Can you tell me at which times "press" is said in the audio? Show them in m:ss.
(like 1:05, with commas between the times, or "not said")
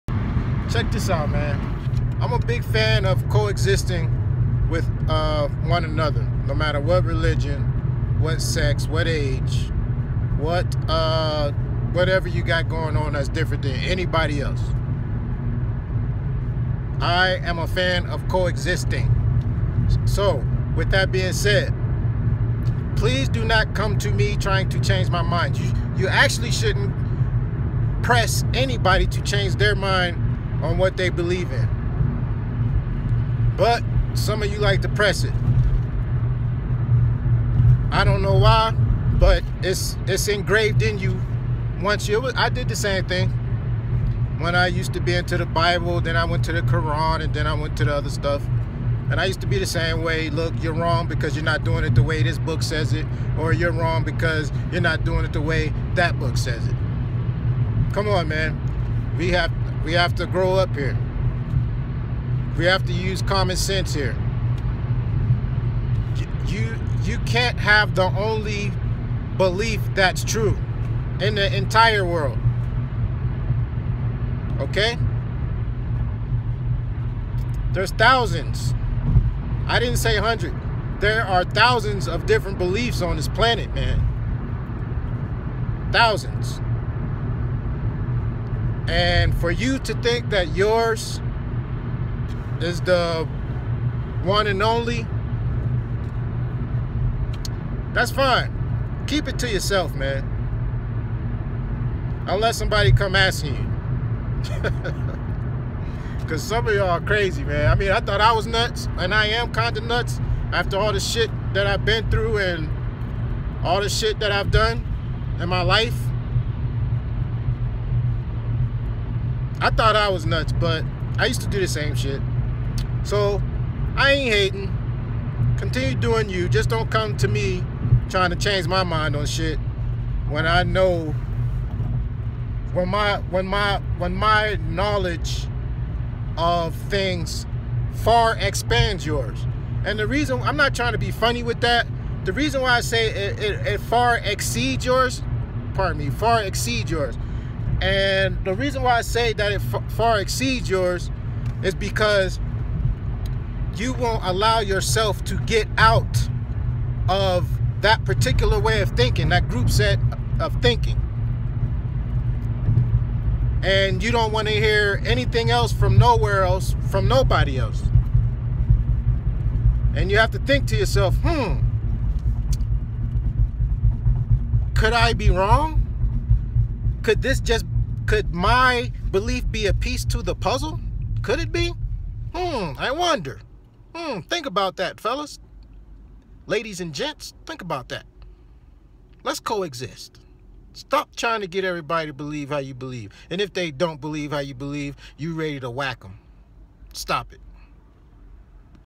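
0:28, 0:34.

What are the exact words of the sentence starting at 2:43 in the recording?
And you don't want to hear anything else from nowhere else, from nobody else.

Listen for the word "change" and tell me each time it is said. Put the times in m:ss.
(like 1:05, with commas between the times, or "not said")
0:24, 0:29, 2:08.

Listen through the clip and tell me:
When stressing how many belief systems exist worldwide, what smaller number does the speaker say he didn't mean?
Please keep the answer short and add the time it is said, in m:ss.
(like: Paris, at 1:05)
100, at 1:20.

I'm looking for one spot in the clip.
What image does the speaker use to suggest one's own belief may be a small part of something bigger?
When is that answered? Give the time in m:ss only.
2:59.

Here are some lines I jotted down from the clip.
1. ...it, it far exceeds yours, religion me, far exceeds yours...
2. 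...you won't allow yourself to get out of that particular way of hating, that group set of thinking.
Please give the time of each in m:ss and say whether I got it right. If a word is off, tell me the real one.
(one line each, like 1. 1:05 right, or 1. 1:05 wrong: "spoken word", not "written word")
1. 2:23 wrong: "pardon", not "religion"
2. 2:33 wrong: "thinking", not "hating".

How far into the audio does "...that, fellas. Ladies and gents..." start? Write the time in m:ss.
3:04.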